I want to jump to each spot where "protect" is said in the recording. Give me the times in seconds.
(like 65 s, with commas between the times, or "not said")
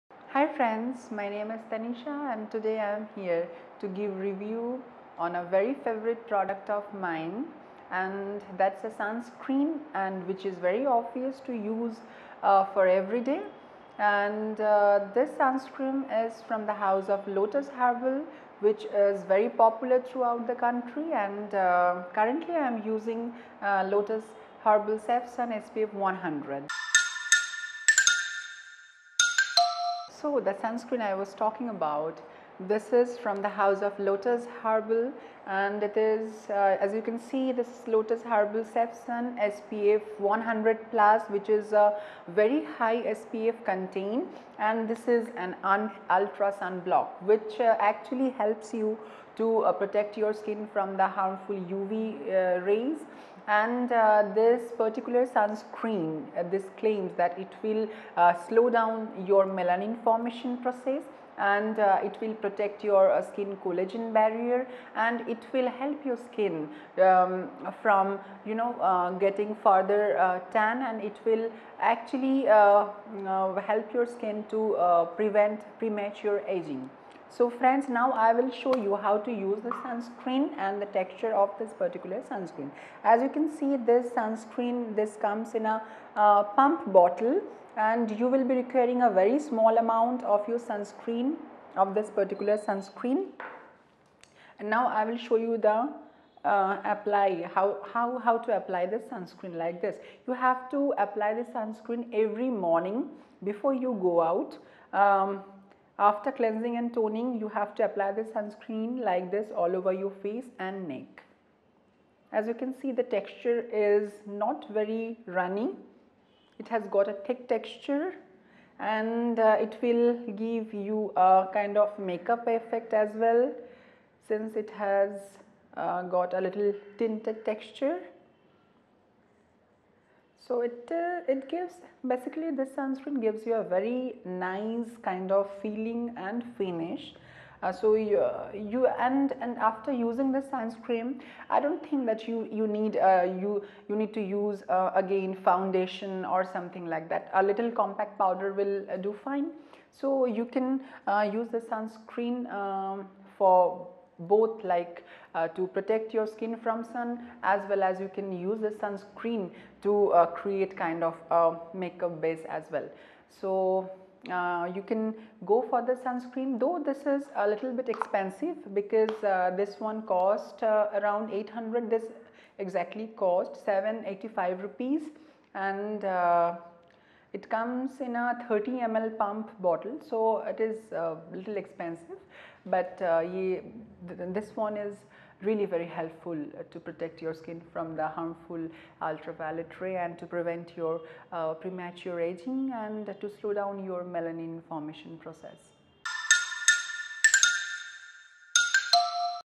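49 s, 62 s, 155 s, 186 s.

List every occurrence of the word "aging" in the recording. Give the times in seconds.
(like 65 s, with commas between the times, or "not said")
76 s, 192 s.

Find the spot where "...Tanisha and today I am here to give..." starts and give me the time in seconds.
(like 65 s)
1 s.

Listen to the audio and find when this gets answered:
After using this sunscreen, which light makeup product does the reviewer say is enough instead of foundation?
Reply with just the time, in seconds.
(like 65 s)
147 s.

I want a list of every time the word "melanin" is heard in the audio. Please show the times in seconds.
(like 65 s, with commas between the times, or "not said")
59 s, 194 s.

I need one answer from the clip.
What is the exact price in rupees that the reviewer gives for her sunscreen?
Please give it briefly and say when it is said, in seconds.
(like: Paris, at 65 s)
785 rupees, at 173 s.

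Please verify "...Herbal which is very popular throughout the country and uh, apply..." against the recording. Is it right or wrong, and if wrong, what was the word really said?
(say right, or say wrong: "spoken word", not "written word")
wrong: "currently", not "apply".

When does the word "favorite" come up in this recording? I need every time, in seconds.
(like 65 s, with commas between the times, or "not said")
5 s.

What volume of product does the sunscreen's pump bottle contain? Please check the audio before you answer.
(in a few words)
30 ml.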